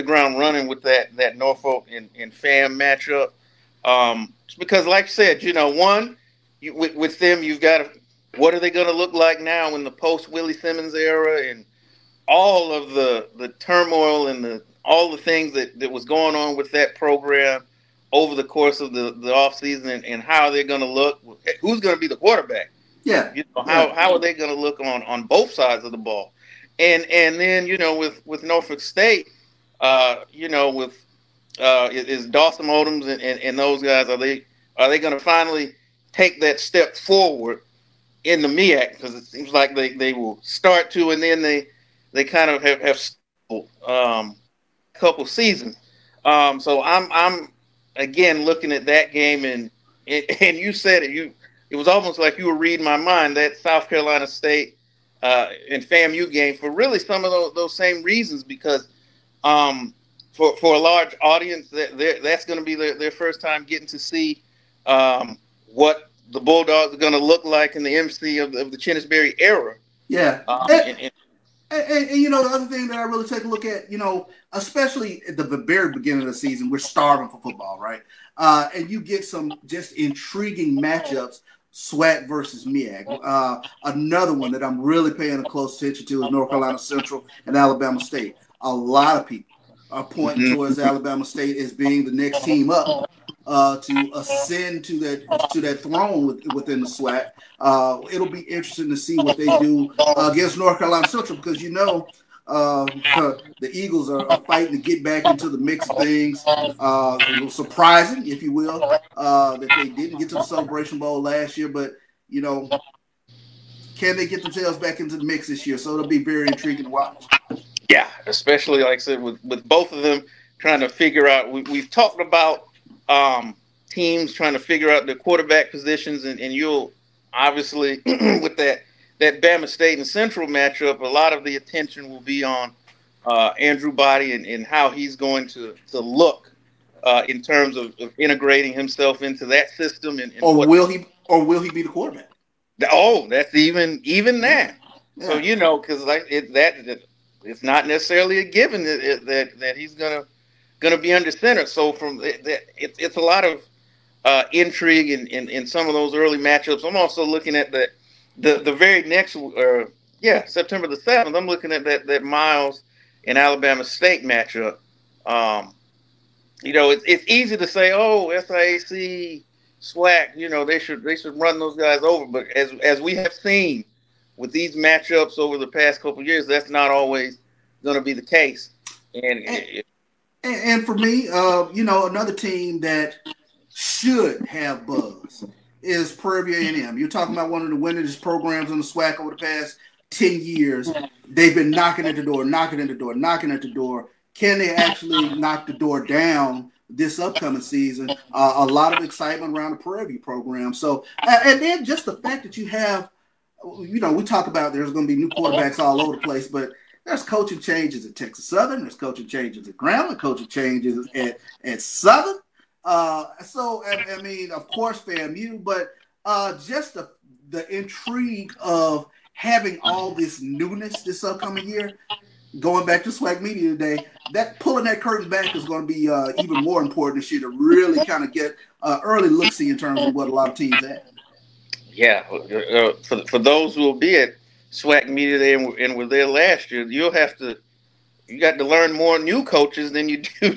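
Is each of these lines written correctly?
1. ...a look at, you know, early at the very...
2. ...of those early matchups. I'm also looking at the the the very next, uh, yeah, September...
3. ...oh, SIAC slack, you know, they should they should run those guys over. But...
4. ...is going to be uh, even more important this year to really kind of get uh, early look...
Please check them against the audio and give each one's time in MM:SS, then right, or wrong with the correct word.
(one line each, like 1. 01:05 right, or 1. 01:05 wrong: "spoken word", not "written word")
1. 01:13 wrong: "especially", not "early"
2. 02:35 right
3. 02:47 right
4. 03:45 right.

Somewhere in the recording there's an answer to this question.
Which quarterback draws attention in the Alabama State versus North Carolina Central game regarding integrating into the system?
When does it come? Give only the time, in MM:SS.
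02:13.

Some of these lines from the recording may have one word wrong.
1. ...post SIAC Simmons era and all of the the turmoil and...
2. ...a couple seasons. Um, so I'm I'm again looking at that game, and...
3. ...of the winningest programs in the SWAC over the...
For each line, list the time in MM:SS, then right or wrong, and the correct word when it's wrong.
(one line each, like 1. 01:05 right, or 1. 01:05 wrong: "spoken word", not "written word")
1. 00:09 wrong: "Willie", not "SIAC"
2. 00:44 right
3. 03:07 right.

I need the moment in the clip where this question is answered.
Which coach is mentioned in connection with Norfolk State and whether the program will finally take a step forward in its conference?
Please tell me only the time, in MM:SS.
00:32.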